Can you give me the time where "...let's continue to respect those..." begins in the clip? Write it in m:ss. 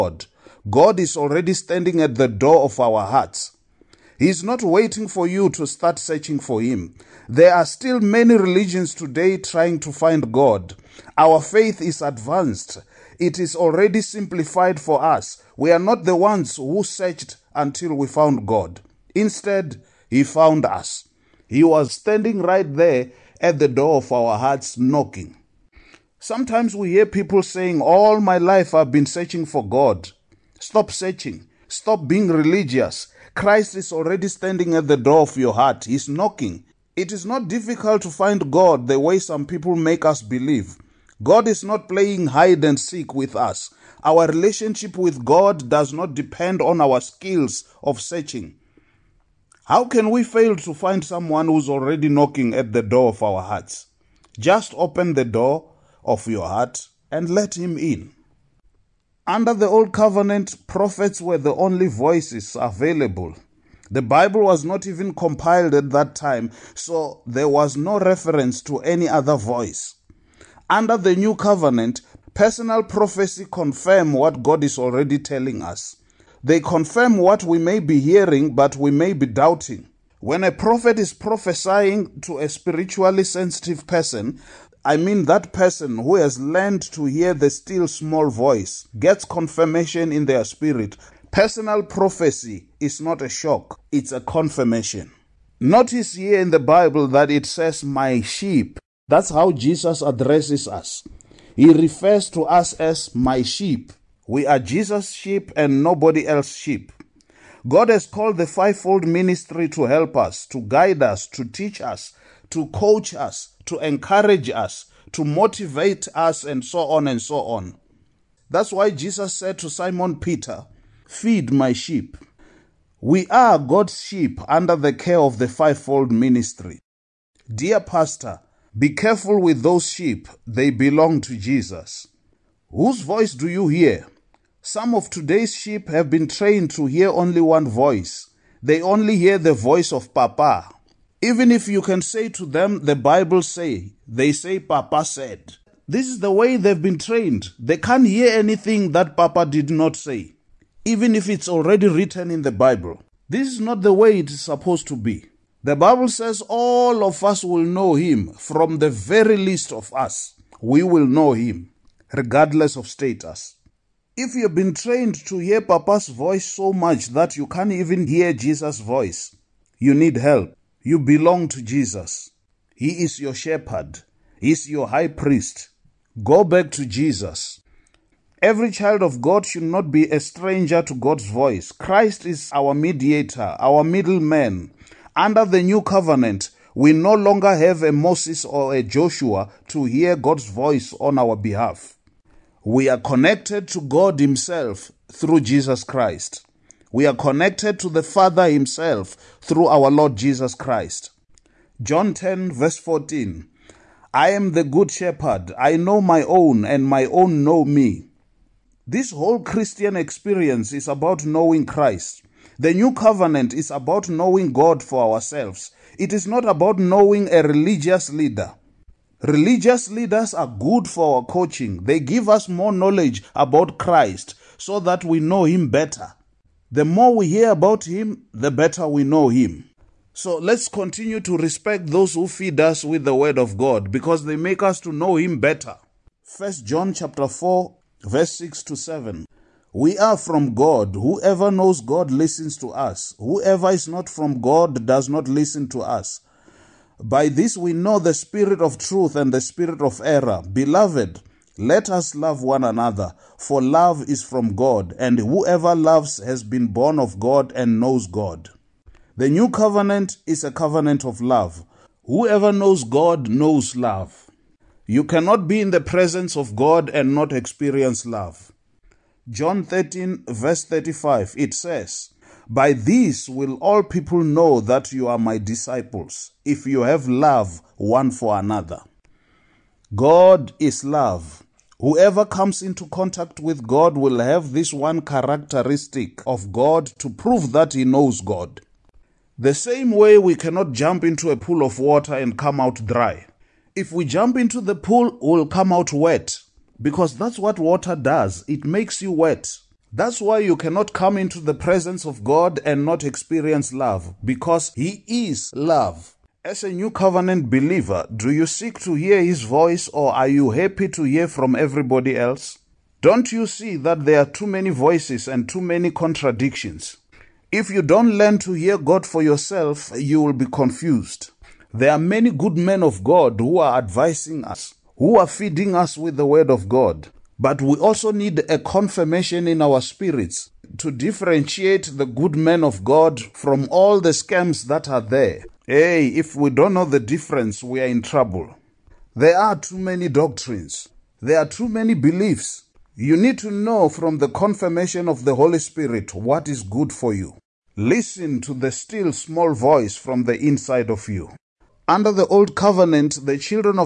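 3:50.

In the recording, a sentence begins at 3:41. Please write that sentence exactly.
They give us more knowledge about Christ so that we know Him better.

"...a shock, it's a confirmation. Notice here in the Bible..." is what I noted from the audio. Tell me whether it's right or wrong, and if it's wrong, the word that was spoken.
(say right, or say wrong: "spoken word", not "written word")
right.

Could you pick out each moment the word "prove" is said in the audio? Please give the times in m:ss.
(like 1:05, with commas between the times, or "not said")
4:47.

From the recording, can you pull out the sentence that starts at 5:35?
Hey, if we don't know the difference, we are in trouble.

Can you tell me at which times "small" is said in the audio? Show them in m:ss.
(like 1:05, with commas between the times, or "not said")
1:27, 5:49.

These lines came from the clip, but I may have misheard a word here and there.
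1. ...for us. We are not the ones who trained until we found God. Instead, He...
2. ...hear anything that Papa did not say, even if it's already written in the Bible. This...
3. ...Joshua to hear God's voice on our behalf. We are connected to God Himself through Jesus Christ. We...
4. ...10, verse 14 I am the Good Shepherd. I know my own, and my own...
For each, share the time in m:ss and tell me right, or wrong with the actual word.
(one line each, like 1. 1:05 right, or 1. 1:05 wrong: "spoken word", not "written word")
1. 0:14 wrong: "searched", not "trained"
2. 2:28 right
3. 3:08 right
4. 3:22 right.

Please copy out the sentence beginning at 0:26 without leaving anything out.
Sometimes we hear people saying, All my life I've been searching for God.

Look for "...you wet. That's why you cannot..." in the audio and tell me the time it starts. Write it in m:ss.
4:59.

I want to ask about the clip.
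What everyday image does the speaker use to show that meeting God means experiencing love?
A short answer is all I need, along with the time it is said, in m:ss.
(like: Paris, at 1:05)
Pool of water, at 4:51.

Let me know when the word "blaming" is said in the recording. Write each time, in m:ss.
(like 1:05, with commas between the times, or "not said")
not said.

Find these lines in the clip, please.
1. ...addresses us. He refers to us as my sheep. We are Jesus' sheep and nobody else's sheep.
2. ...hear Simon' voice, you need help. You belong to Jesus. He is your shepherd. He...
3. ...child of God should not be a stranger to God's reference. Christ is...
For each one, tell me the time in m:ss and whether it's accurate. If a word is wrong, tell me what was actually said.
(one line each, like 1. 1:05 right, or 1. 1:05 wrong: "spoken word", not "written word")
1. 1:40 right
2. 2:48 wrong: "Jesus", not "Simon"
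3. 2:58 wrong: "voice", not "reference".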